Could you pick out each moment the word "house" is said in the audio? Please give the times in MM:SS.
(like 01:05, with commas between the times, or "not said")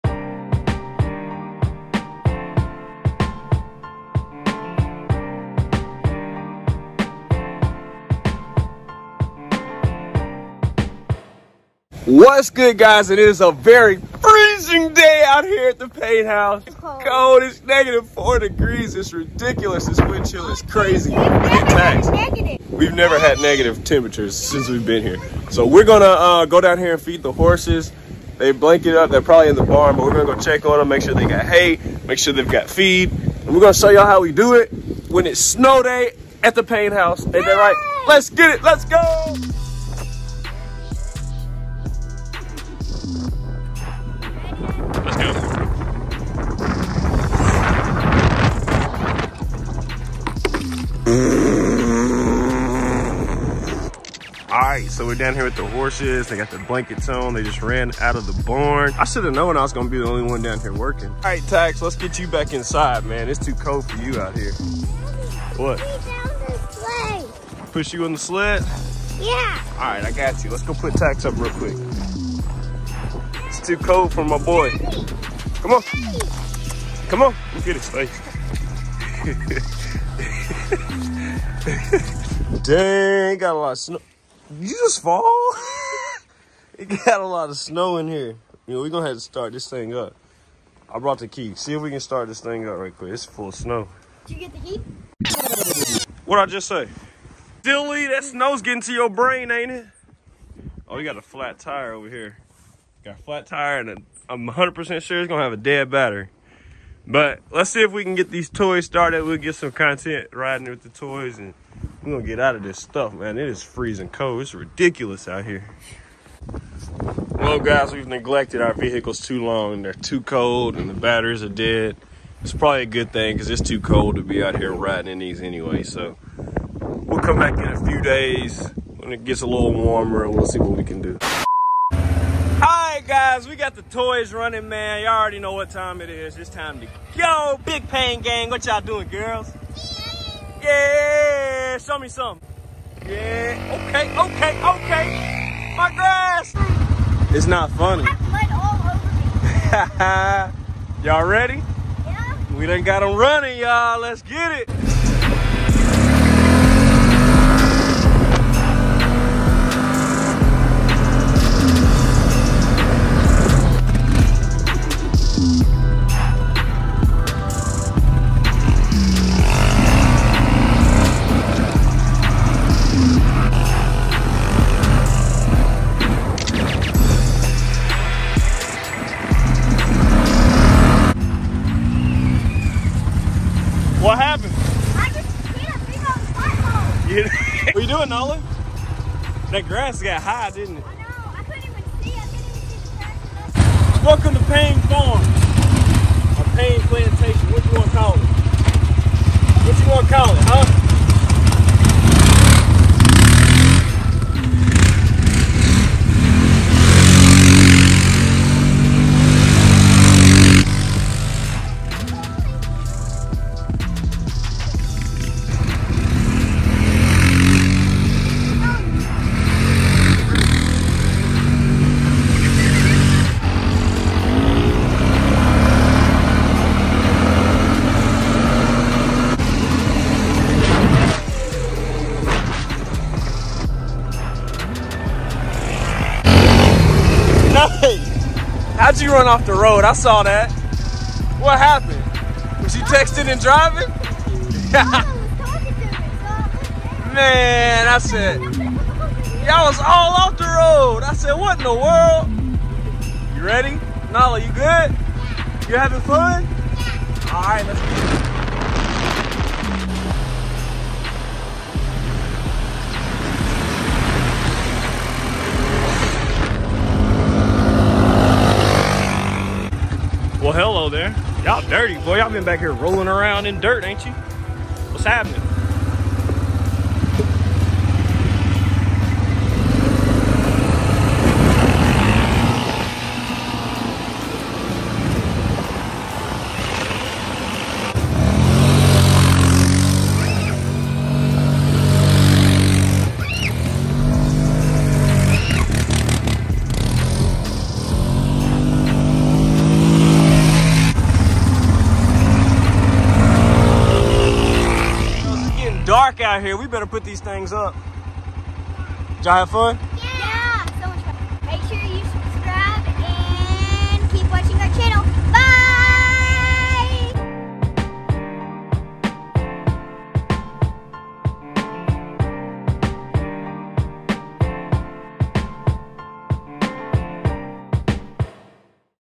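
00:16, 00:36.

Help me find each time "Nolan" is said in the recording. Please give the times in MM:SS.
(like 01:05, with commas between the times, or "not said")
03:08.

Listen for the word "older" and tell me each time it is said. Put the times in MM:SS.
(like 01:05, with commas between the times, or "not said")
not said.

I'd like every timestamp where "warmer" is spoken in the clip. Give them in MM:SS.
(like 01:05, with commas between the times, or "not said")
02:09.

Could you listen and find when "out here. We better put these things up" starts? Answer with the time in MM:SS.
05:06.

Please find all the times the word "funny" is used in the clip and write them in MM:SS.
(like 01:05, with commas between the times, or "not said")
02:27.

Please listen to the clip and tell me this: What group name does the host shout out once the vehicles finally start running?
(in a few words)
Big Payne Gang.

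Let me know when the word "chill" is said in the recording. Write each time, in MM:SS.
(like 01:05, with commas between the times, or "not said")
00:20.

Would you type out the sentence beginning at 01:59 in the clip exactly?
They're too cold and the batteries are dead.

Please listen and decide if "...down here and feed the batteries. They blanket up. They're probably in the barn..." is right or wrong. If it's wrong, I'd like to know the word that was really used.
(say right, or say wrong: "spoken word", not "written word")
wrong: "horses", not "batteries".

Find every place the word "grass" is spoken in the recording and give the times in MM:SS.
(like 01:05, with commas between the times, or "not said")
02:25, 03:09.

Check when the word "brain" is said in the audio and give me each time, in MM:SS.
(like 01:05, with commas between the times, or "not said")
01:39.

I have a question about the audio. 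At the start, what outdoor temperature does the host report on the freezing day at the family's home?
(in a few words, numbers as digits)
-4 degrees.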